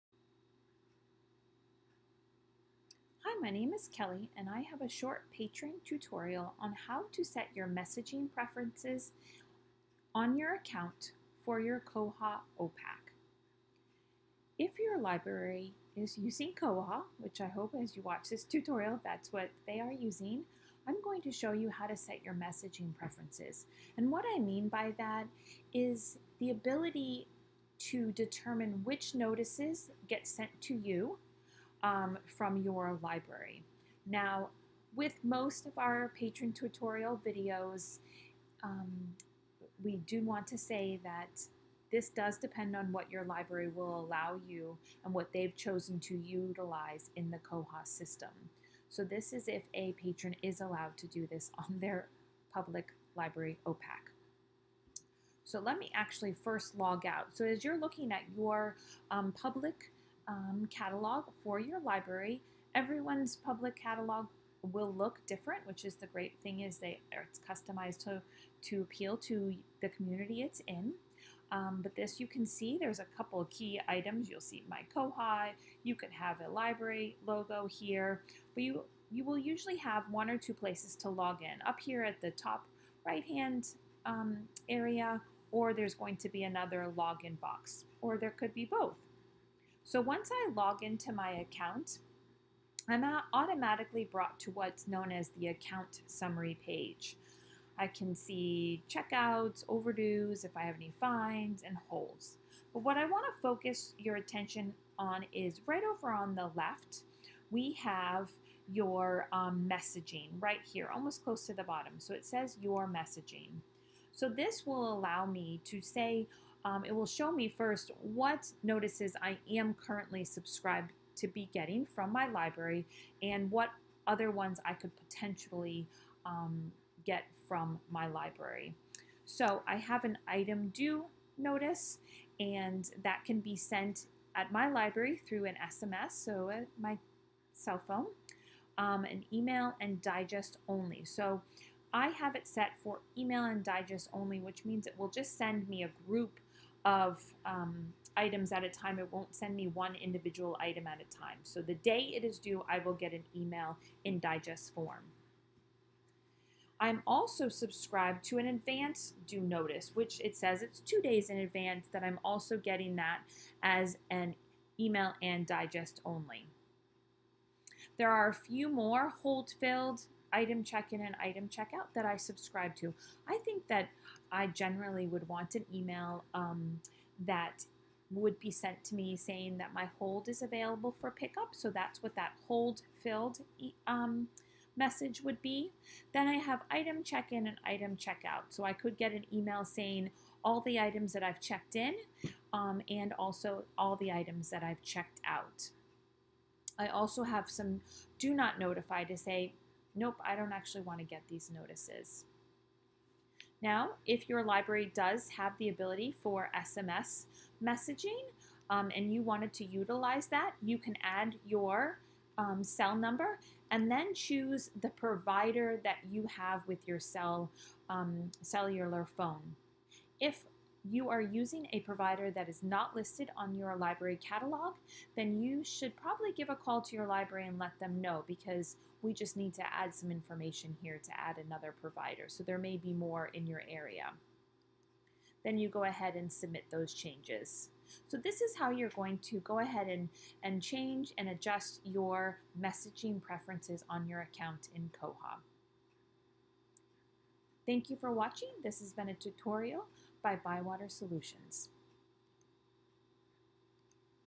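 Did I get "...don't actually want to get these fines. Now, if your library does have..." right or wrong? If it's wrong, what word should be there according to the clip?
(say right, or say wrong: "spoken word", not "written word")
wrong: "notices", not "fines".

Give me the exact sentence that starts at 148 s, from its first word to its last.
It won't send me one individual item at a time.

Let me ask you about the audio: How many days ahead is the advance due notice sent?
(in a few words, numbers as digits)
2.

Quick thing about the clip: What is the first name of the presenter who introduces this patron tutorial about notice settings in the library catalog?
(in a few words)
Kelly.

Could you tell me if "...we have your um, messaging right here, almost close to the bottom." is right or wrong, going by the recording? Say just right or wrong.
right.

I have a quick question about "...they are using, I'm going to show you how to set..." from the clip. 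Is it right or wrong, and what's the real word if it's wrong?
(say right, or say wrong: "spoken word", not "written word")
right.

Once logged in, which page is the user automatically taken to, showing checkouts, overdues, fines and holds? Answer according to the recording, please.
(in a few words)
Account summary page.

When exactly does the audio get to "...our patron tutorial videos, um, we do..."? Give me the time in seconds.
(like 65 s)
35 s.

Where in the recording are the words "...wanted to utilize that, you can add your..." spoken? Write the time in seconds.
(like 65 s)
209 s.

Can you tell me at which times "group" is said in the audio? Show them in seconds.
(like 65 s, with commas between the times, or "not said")
146 s.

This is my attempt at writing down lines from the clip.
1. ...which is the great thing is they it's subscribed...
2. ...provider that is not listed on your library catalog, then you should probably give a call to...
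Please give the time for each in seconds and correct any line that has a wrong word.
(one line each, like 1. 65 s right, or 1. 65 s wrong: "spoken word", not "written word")
1. 65 s wrong: "customized", not "subscribed"
2. 221 s right.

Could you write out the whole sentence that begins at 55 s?
So let me actually first log out.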